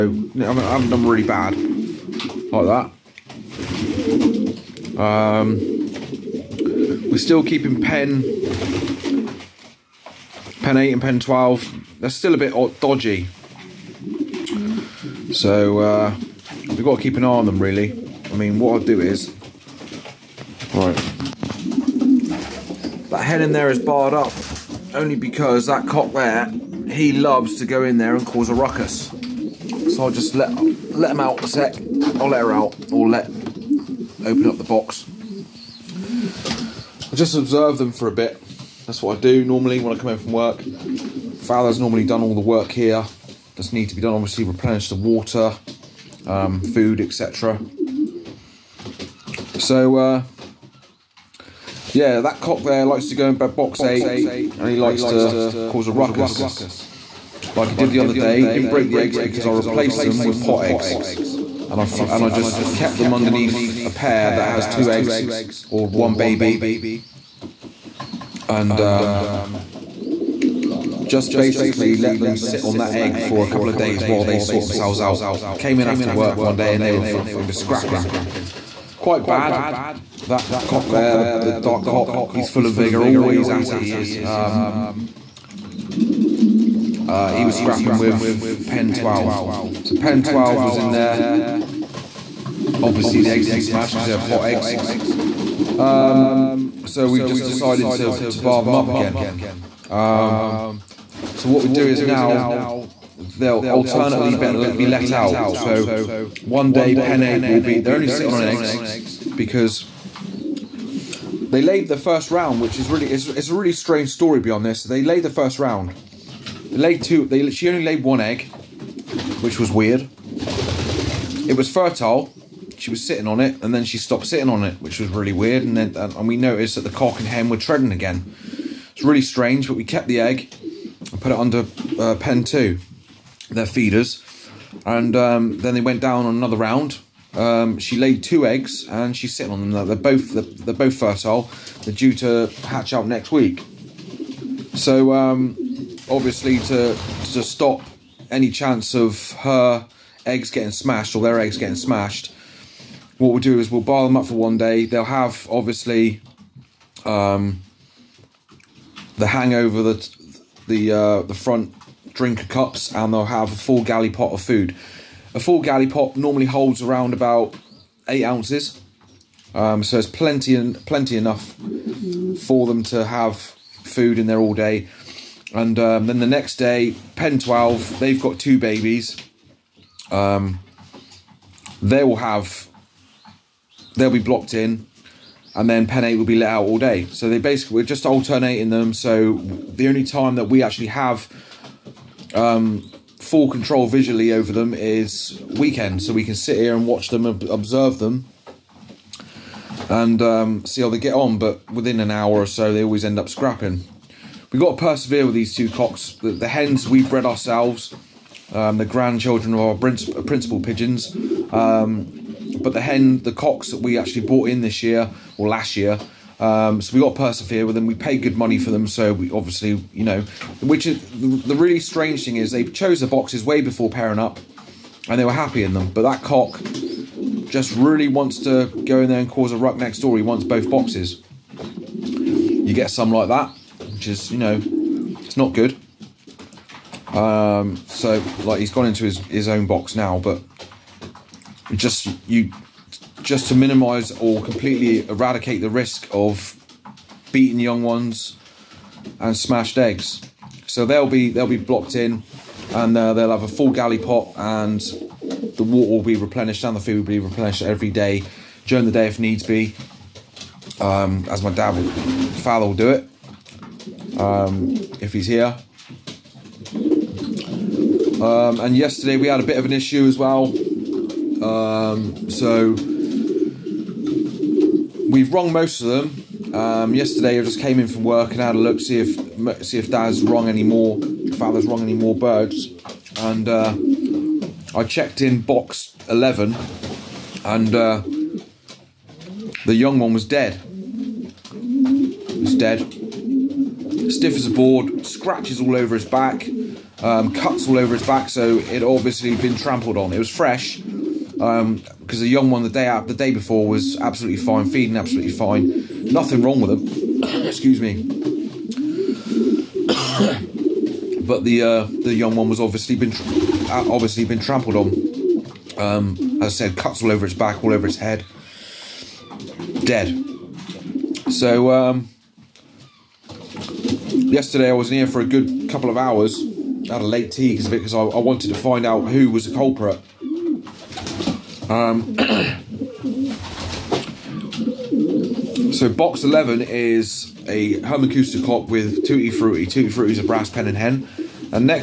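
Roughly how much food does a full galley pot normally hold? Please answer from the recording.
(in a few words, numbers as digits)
8 ounces.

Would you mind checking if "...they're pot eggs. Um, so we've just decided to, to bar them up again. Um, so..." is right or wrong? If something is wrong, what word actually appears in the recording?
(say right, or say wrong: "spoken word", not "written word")
right.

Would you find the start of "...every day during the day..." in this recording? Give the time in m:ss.
4:17.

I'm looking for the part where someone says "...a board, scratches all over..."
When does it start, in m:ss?
4:54.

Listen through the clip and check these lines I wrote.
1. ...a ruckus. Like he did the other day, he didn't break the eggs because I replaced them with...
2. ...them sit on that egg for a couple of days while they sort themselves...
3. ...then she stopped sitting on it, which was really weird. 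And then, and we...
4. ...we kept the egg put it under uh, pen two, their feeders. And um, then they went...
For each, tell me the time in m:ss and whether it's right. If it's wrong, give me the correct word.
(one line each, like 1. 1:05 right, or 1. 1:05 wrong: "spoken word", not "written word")
1. 0:55 right
2. 1:12 right
3. 2:03 right
4. 2:09 right.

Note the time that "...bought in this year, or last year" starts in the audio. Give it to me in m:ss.
3:34.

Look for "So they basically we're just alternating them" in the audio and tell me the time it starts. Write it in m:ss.
3:07.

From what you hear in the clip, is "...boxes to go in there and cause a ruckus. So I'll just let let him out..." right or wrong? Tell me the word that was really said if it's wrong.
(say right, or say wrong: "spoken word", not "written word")
wrong: "loves", not "boxes".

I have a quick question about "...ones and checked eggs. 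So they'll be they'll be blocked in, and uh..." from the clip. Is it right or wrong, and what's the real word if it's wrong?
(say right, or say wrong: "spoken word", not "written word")
wrong: "smashed", not "checked".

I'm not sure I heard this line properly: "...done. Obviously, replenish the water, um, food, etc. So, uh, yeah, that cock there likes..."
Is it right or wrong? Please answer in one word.
right.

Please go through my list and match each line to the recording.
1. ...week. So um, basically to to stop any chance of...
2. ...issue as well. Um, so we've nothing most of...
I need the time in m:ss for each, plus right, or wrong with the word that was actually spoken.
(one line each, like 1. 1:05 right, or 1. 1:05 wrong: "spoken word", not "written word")
1. 2:23 wrong: "obviously", not "basically"
2. 4:29 wrong: "wrong", not "nothing".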